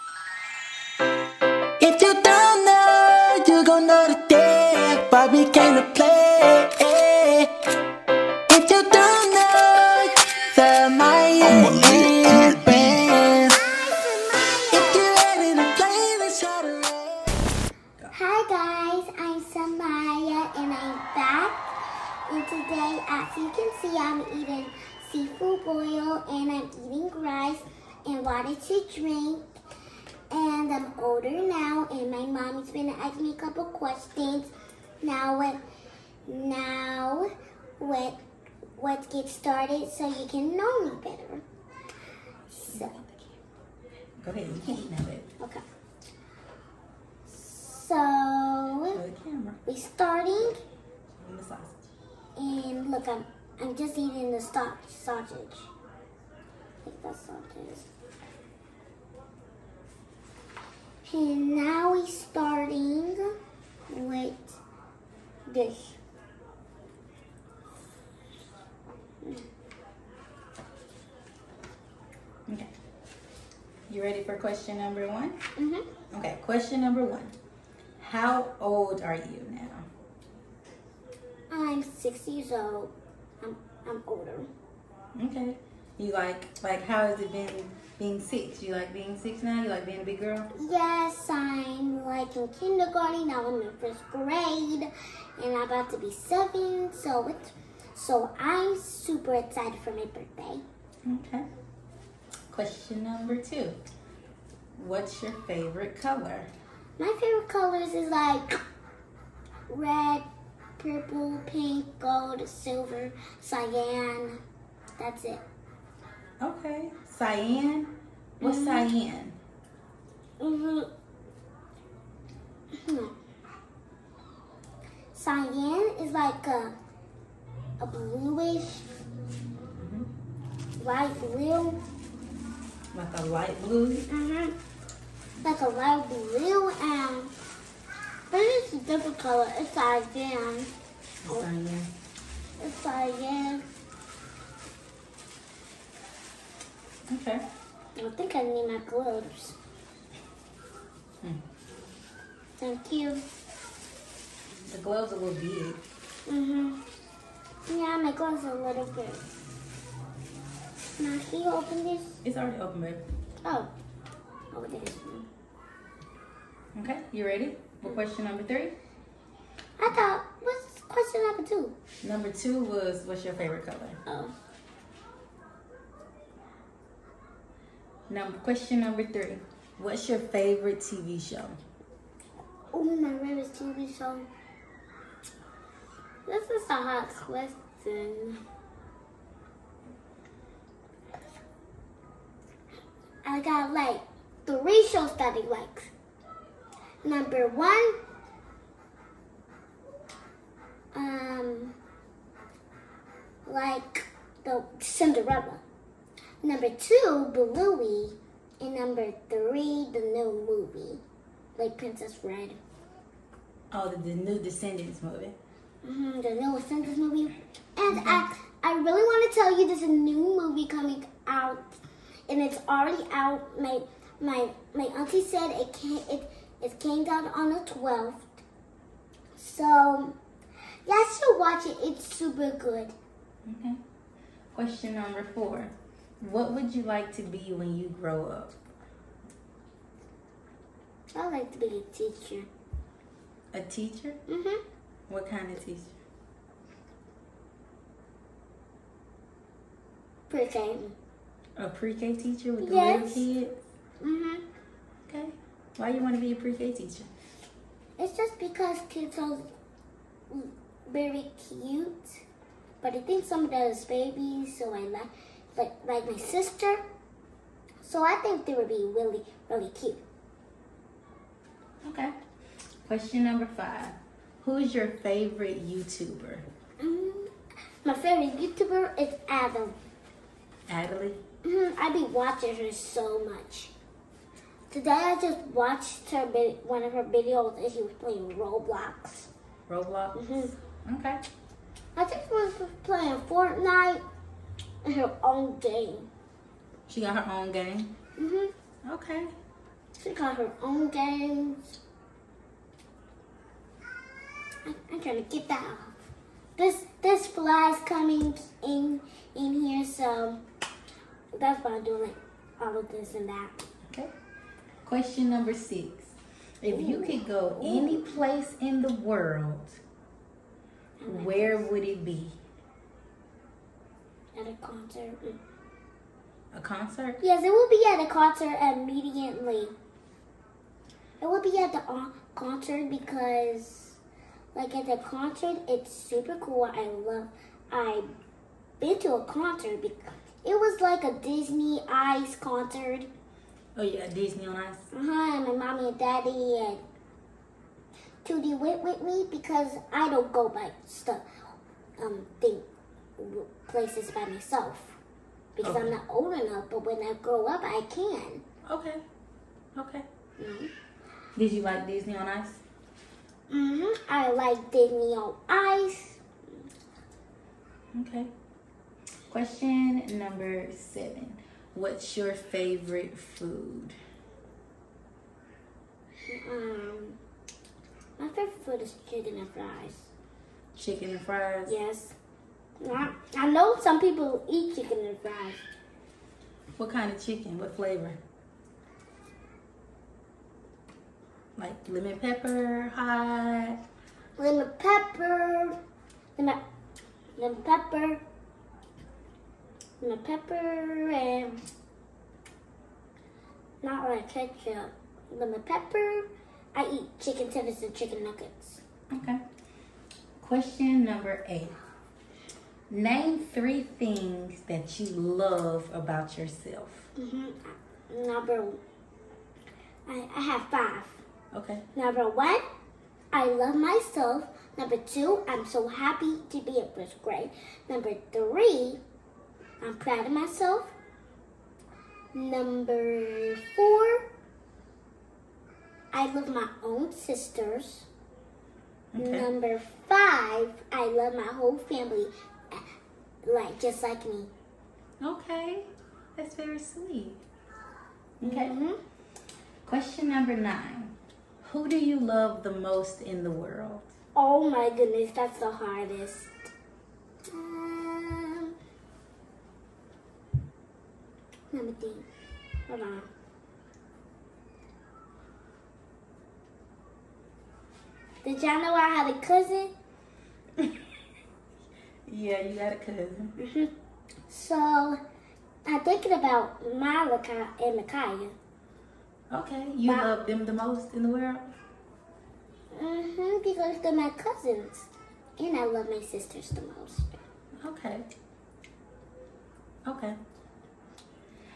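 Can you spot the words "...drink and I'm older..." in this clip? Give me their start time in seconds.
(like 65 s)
28 s.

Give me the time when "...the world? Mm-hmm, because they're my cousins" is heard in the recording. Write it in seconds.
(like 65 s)
481 s.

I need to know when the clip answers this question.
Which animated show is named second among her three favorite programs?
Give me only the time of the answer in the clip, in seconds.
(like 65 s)
206 s.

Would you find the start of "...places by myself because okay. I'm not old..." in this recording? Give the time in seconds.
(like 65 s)
353 s.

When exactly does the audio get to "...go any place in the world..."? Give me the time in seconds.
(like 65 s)
317 s.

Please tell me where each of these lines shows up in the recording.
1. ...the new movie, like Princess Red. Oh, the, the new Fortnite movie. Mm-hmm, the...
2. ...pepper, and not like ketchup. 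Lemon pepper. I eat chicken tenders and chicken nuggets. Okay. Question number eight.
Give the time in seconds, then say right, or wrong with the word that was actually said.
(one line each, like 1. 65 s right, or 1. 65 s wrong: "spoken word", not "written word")
1. 209 s wrong: "Descendants", not "Fortnite"
2. 400 s right.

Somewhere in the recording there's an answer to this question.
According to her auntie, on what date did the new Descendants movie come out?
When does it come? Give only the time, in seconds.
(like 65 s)
226 s.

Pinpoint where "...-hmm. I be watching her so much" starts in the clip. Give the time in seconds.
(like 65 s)
281 s.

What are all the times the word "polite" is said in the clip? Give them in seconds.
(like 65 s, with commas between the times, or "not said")
not said.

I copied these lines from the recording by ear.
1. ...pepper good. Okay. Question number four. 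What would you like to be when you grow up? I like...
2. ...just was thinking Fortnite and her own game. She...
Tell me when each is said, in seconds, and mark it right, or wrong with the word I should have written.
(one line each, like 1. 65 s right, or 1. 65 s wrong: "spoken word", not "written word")
1. 232 s wrong: "super", not "pepper"
2. 292 s wrong: "playing", not "thinking".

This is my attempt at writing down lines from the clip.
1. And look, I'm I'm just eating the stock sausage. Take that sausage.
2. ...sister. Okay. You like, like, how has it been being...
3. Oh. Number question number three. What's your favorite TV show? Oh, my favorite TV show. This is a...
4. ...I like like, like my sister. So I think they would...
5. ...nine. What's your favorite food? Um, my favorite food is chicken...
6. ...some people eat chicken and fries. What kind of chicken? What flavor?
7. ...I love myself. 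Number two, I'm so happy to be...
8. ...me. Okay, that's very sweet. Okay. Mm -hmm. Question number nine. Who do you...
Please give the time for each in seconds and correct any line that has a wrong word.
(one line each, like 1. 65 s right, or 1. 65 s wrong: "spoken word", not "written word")
1. 52 s right
2. 84 s wrong: "older", not "sister"
3. 174 s right
4. 264 s right
5. 370 s wrong: "seven", not "nine"
6. 383 s right
7. 423 s right
8. 444 s right.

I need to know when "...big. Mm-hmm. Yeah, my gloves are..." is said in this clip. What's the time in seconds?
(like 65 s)
155 s.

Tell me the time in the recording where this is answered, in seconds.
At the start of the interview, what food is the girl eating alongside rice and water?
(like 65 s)
25 s.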